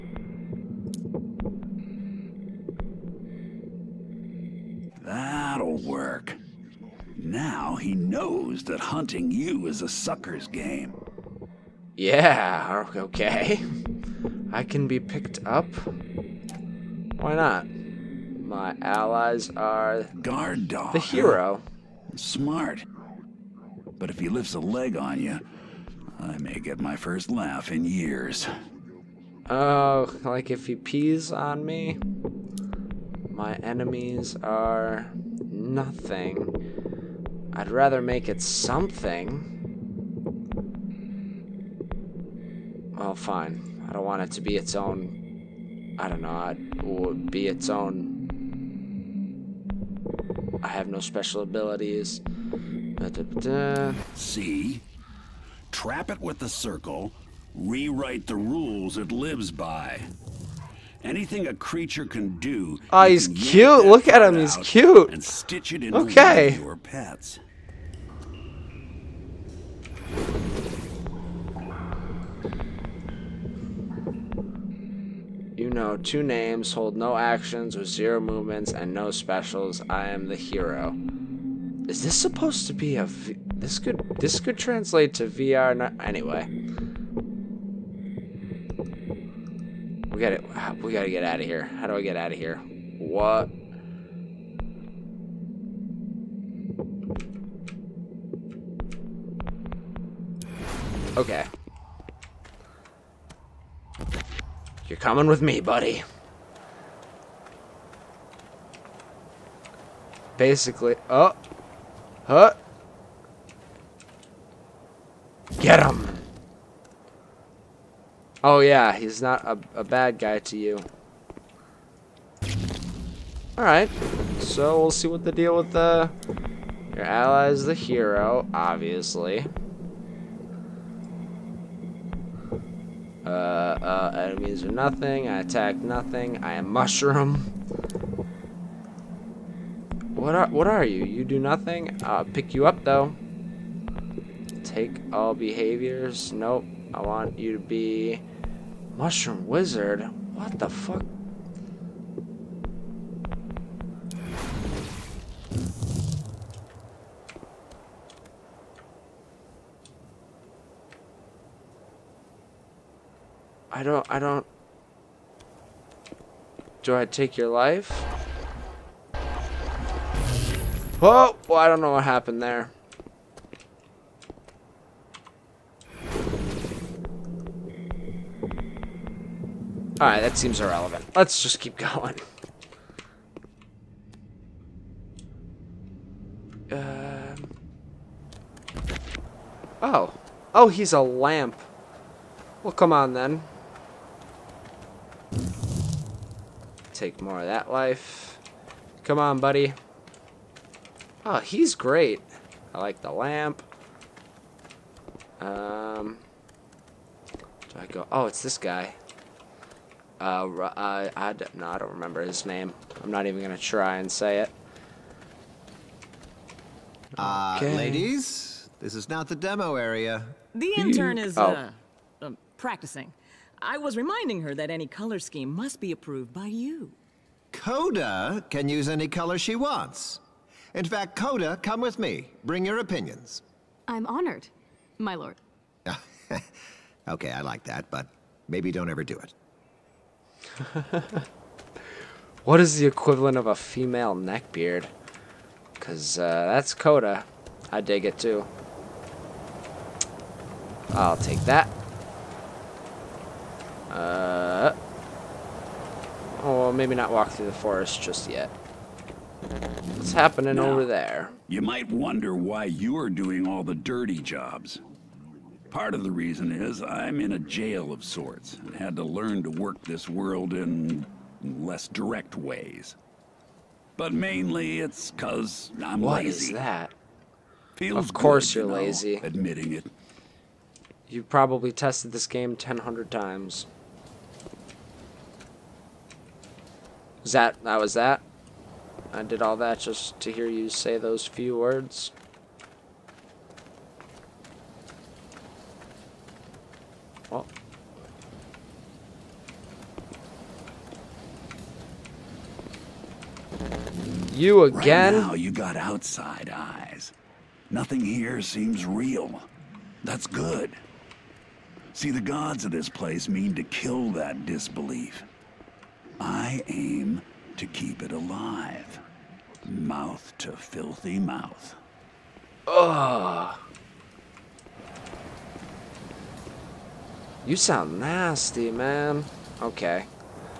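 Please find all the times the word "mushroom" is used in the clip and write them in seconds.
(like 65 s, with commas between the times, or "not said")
136 s, 148 s.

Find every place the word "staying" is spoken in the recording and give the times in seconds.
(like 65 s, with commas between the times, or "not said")
not said.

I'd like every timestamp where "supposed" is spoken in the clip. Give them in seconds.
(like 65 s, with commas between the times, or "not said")
82 s.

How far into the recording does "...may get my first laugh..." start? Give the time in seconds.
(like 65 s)
26 s.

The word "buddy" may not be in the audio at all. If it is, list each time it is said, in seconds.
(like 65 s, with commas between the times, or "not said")
105 s, 199 s.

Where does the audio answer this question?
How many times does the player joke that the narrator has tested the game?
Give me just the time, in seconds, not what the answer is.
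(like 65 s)
282 s.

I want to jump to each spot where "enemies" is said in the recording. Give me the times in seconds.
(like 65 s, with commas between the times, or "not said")
33 s, 134 s.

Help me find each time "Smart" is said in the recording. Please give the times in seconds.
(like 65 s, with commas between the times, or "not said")
22 s.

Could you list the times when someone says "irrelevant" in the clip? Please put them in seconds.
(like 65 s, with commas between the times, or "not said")
180 s.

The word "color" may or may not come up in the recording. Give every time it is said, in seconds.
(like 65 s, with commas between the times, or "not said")
224 s, 229 s.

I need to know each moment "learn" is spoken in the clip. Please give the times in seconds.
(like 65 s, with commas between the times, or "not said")
269 s.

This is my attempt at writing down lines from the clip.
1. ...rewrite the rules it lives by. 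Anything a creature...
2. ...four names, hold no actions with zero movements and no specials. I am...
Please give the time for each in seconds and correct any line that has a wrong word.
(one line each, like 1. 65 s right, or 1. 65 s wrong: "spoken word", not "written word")
1. 57 s right
2. 75 s wrong: "two", not "four".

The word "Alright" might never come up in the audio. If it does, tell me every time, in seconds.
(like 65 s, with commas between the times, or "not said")
123 s, 180 s.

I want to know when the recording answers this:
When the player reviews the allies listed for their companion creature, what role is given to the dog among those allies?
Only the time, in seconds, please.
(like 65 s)
20 s.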